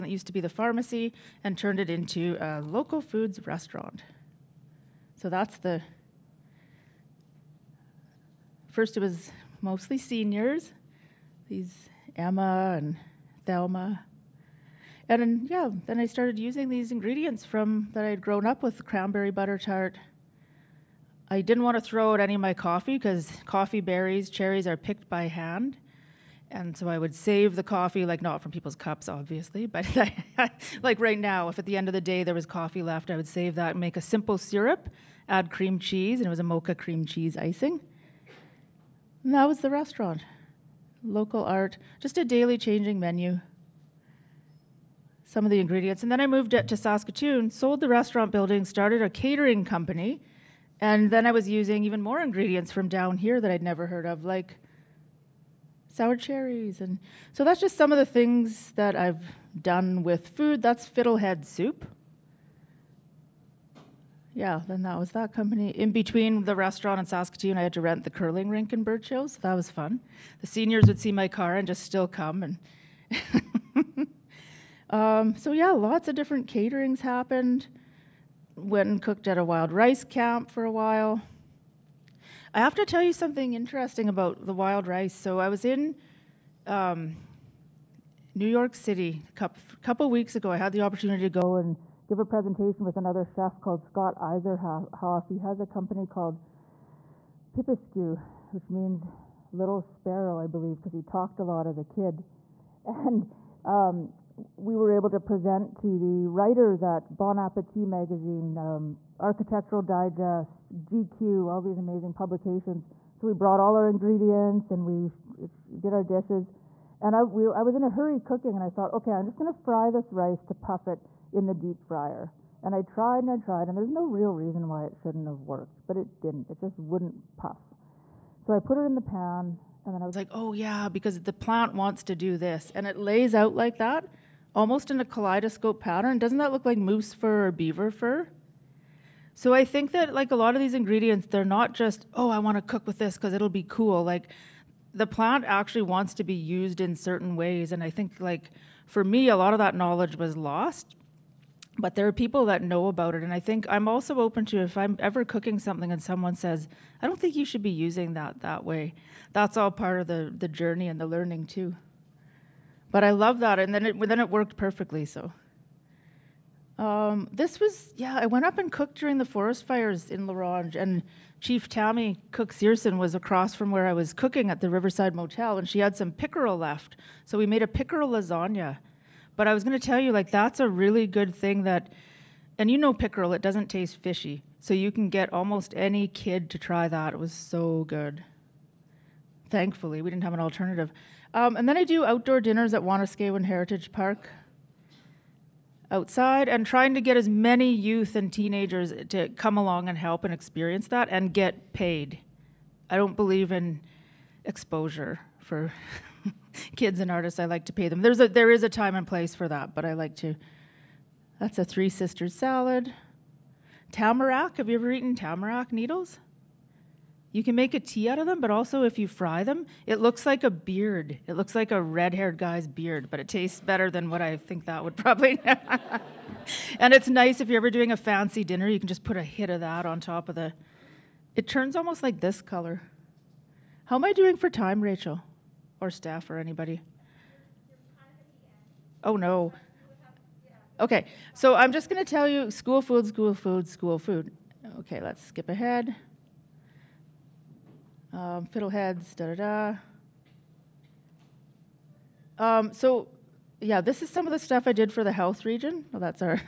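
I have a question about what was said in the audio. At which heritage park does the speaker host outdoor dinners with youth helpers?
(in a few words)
Wanuskewin Heritage Park.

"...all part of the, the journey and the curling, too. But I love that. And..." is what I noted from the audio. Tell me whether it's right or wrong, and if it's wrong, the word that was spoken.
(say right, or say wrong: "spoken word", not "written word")
wrong: "learning", not "curling".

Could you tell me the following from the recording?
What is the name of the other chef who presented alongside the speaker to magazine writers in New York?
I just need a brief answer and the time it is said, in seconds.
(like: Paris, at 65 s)
Scott Iserhoff, at 93 s.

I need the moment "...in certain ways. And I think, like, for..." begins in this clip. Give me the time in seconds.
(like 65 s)
146 s.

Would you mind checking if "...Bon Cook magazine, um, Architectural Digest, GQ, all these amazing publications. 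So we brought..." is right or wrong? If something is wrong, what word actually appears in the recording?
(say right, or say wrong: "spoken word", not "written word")
wrong: "Appetit", not "Cook".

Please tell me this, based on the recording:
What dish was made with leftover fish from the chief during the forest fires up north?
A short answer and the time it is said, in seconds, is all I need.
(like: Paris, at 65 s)
pickerel lasagna, at 177 s.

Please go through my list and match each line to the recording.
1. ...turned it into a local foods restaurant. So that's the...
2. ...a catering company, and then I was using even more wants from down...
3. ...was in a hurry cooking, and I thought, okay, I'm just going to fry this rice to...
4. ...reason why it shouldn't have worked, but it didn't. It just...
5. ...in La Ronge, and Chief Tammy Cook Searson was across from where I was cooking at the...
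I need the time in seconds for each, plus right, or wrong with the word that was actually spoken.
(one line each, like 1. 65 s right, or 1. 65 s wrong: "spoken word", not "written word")
1. 1 s right
2. 49 s wrong: "ingredients", not "wants"
3. 117 s right
4. 124 s right
5. 170 s right.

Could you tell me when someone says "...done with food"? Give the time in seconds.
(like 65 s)
59 s.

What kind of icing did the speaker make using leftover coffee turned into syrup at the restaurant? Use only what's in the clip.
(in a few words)
mocha cream cheese icing.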